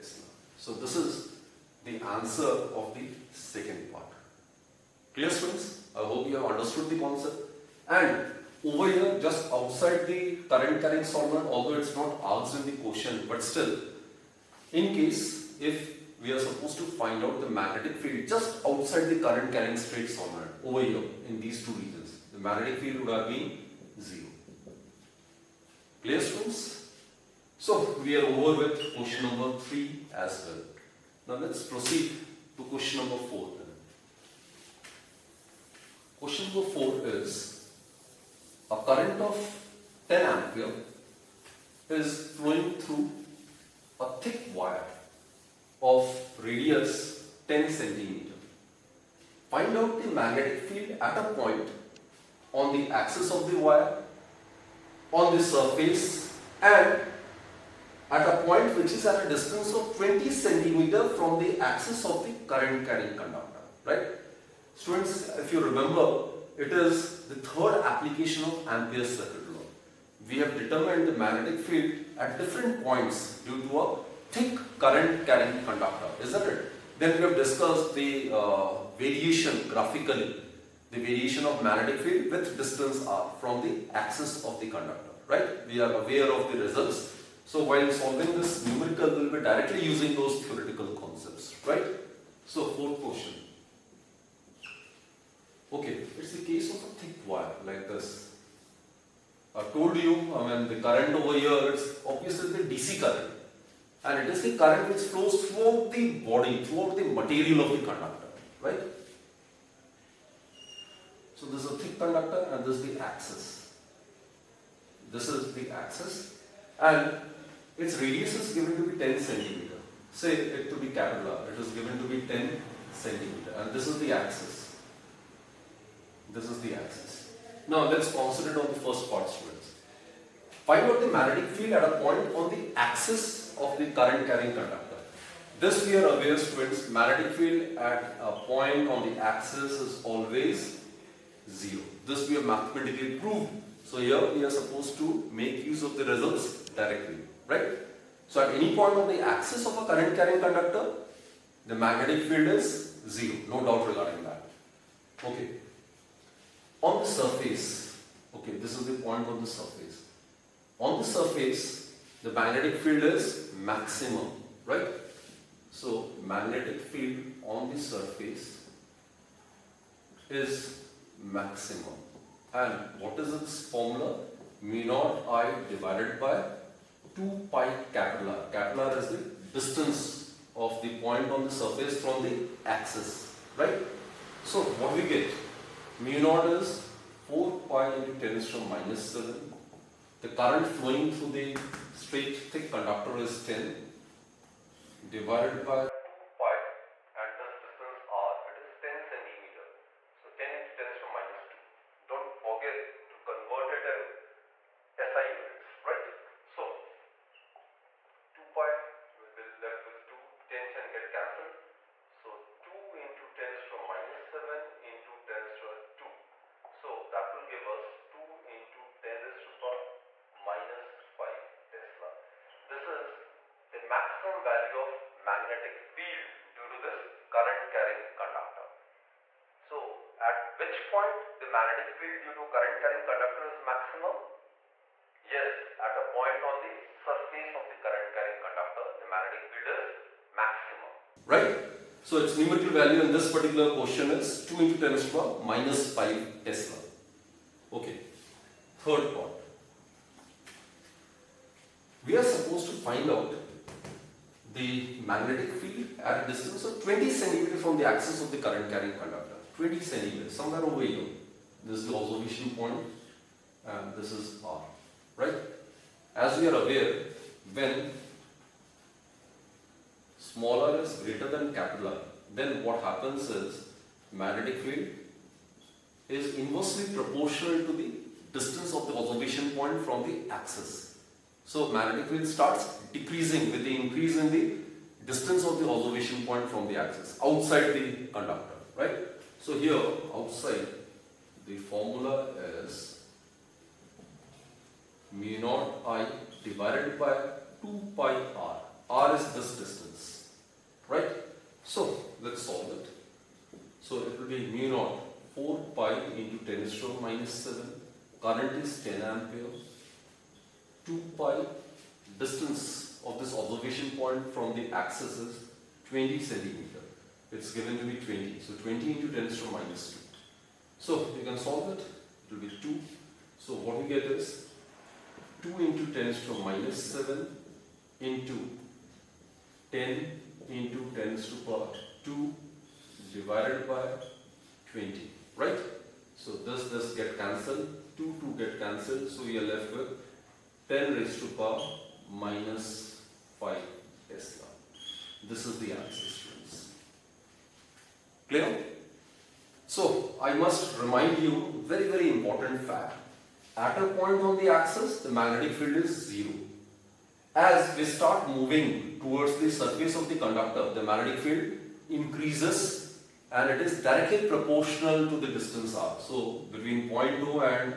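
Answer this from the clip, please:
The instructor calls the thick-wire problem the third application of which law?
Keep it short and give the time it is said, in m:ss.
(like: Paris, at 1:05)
Ampere's circuital law, at 1:08.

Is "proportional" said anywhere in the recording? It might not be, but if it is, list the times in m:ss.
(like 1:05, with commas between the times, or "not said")
4:36, 6:04.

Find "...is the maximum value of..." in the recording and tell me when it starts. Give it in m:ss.
3:42.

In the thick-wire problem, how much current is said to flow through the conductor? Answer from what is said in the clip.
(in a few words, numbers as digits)
10 ampere.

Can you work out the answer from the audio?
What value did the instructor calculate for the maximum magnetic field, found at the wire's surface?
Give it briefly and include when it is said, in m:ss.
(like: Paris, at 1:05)
2 × 10^-5 Tesla, at 3:38.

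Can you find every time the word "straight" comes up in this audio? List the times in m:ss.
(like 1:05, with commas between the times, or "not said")
0:19, 3:11.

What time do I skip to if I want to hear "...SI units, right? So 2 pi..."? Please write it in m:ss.
3:25.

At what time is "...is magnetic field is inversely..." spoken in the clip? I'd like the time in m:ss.
4:33.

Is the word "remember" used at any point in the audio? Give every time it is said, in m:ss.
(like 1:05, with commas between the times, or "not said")
1:05.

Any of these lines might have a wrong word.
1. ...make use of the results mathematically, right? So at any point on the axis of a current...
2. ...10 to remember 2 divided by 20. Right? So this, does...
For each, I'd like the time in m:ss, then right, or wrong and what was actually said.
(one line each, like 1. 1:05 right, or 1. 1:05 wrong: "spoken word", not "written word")
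1. 2:25 wrong: "directly", not "mathematically"
2. 5:30 wrong: "power", not "remember".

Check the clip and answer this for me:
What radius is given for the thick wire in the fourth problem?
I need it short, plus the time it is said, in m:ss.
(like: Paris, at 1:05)
10 centimeter, at 0:46.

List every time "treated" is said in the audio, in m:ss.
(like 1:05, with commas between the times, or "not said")
not said.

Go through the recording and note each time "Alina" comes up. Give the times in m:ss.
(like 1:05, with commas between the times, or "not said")
not said.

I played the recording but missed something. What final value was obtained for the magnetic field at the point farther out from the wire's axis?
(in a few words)
10^-5 Tesla.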